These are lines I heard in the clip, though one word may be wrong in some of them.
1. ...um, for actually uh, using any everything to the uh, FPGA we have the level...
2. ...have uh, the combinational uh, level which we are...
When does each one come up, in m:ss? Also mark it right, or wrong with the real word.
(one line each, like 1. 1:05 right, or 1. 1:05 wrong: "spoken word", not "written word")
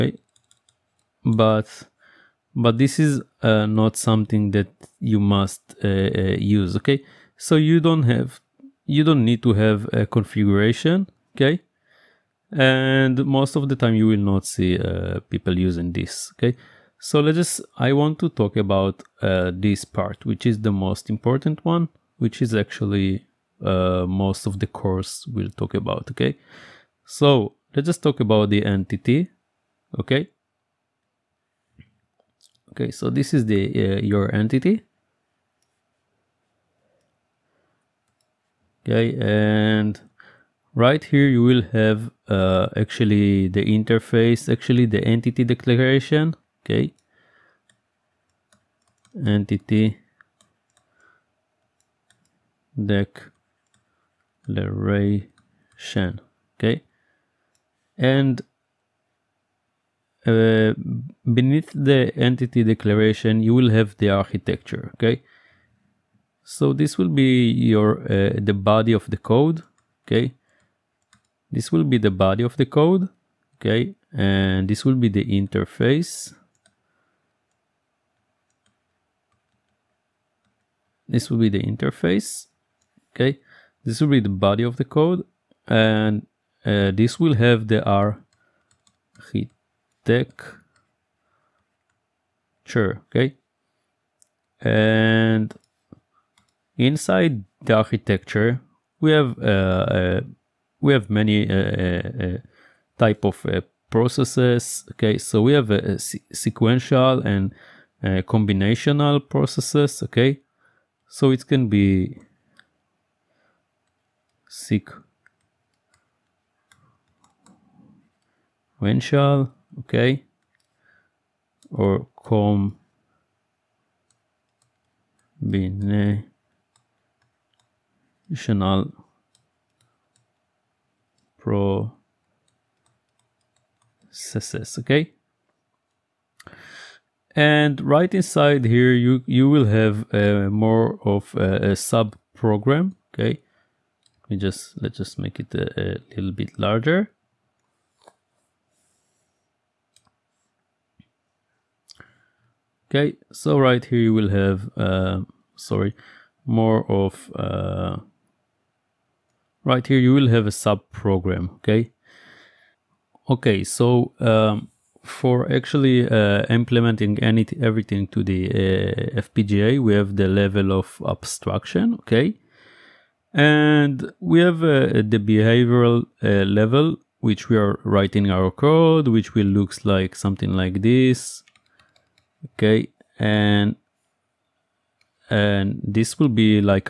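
1. 2:44 wrong: "implementing", not "using"
2. 2:54 wrong: "behavioral", not "combinational".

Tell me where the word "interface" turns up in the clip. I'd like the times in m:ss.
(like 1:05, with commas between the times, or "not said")
0:43, 1:15, 1:21.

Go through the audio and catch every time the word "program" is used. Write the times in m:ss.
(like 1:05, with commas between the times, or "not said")
2:22, 2:40.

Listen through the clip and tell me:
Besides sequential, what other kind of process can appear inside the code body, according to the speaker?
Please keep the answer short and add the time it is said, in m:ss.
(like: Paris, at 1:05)
Combinational, at 1:48.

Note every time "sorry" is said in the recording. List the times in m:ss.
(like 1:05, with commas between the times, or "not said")
2:35.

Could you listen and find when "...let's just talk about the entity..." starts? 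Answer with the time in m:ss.
0:27.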